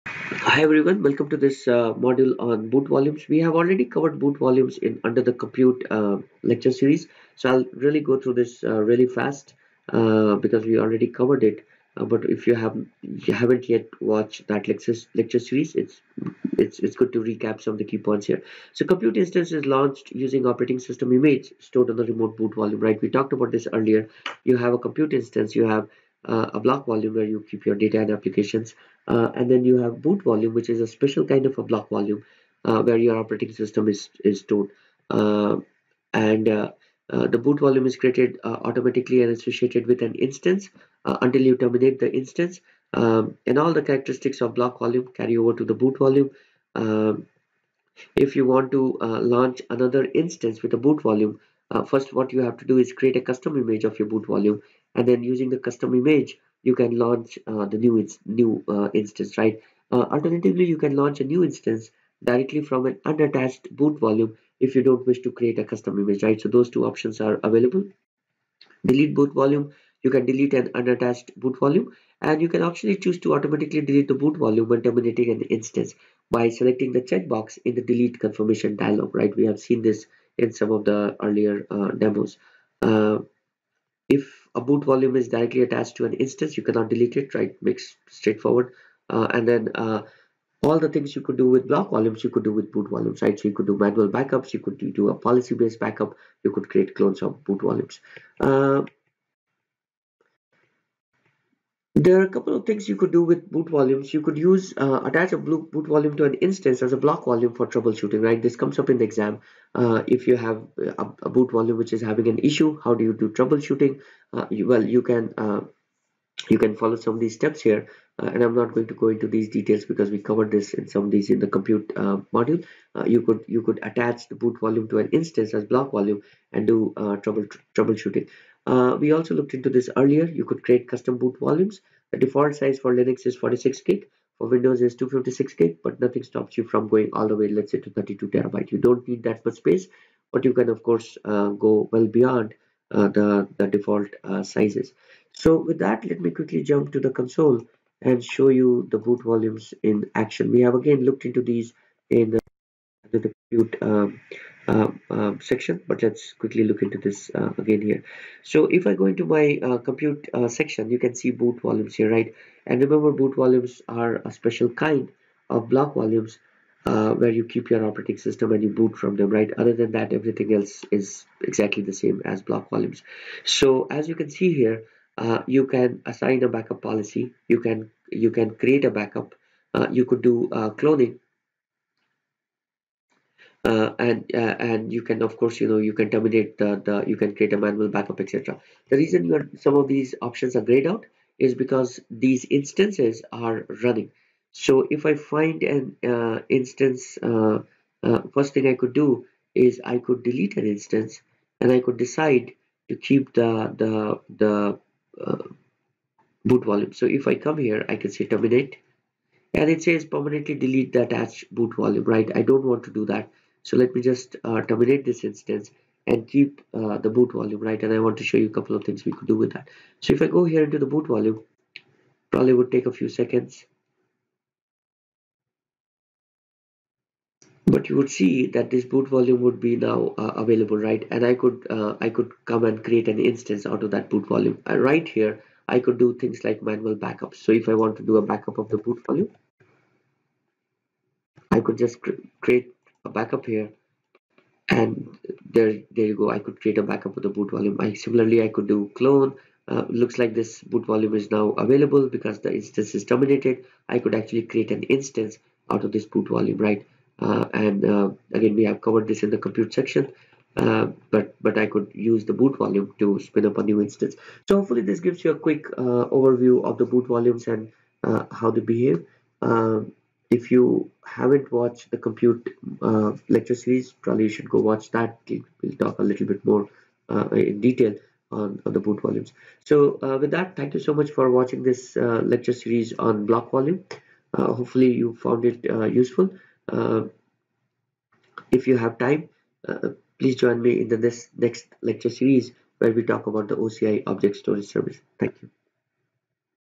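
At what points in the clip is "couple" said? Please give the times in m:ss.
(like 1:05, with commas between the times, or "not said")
1:42, 3:38.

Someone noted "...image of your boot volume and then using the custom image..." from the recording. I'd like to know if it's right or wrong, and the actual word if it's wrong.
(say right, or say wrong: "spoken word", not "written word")
right.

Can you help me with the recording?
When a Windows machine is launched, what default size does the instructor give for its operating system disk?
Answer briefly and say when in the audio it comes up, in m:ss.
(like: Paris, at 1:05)
256 GB, at 2:14.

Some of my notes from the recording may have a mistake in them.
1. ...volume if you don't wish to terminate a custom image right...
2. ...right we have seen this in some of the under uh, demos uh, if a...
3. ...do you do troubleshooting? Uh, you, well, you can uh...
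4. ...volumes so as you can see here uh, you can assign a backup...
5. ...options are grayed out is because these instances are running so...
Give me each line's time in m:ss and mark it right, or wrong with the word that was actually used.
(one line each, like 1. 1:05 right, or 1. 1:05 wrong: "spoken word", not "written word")
1. 1:03 wrong: "create", not "terminate"
2. 1:19 wrong: "earlier", not "under"
3. 1:52 right
4. 2:52 right
5. 3:10 right.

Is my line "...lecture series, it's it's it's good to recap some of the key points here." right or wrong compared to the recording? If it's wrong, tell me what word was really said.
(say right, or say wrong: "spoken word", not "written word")
right.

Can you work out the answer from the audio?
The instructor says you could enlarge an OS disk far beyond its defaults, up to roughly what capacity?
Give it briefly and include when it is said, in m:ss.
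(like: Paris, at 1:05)
32 TB, at 2:17.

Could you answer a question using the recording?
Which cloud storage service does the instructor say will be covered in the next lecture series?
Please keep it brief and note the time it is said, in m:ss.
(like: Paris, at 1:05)
OCI Object Storage, at 4:53.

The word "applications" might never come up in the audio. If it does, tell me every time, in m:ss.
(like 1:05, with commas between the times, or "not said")
0:28.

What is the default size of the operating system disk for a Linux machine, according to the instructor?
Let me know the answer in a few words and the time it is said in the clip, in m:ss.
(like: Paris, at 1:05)
46 GB, at 2:13.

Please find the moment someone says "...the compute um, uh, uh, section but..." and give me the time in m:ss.
2:33.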